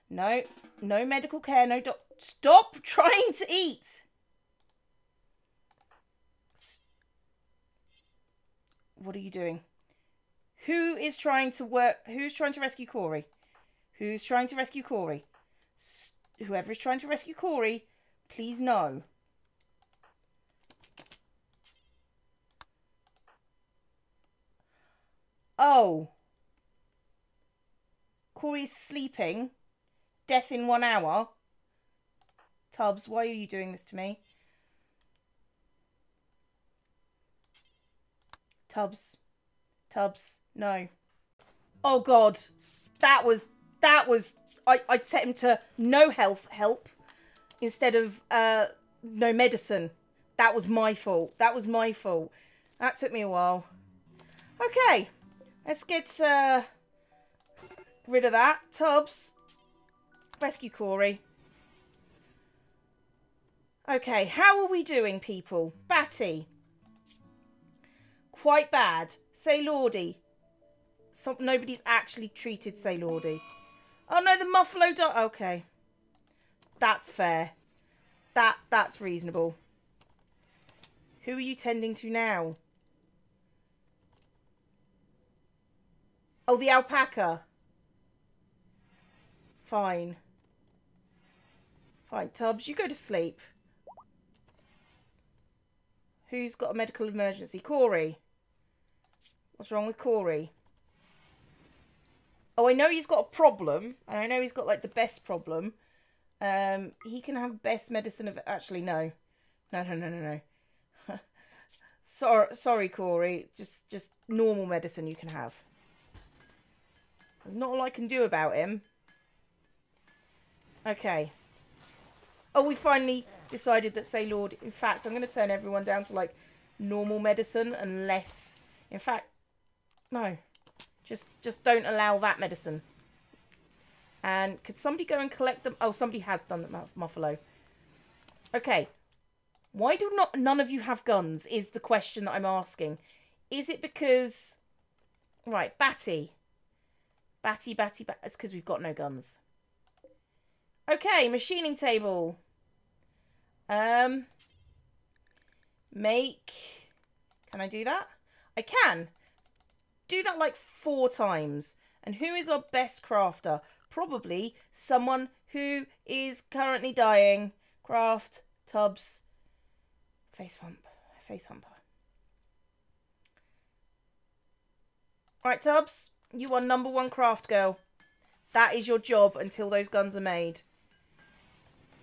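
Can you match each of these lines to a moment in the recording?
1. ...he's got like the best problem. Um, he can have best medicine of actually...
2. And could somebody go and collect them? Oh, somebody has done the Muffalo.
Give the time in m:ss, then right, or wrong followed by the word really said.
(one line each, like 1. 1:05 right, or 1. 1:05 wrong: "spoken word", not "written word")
1. 1:44 right
2. 2:14 right.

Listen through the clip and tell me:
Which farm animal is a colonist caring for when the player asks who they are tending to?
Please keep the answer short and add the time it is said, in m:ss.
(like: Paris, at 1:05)
Alpaca, at 1:26.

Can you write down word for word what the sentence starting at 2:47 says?
Craft, tubbs, face hump, face humper.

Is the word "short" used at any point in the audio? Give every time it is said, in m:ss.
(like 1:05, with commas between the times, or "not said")
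not said.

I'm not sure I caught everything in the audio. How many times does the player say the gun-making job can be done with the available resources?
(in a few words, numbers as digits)
4.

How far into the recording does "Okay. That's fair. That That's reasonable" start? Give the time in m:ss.
1:15.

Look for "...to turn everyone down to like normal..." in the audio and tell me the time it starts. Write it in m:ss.
2:05.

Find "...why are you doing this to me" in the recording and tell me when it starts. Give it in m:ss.
0:33.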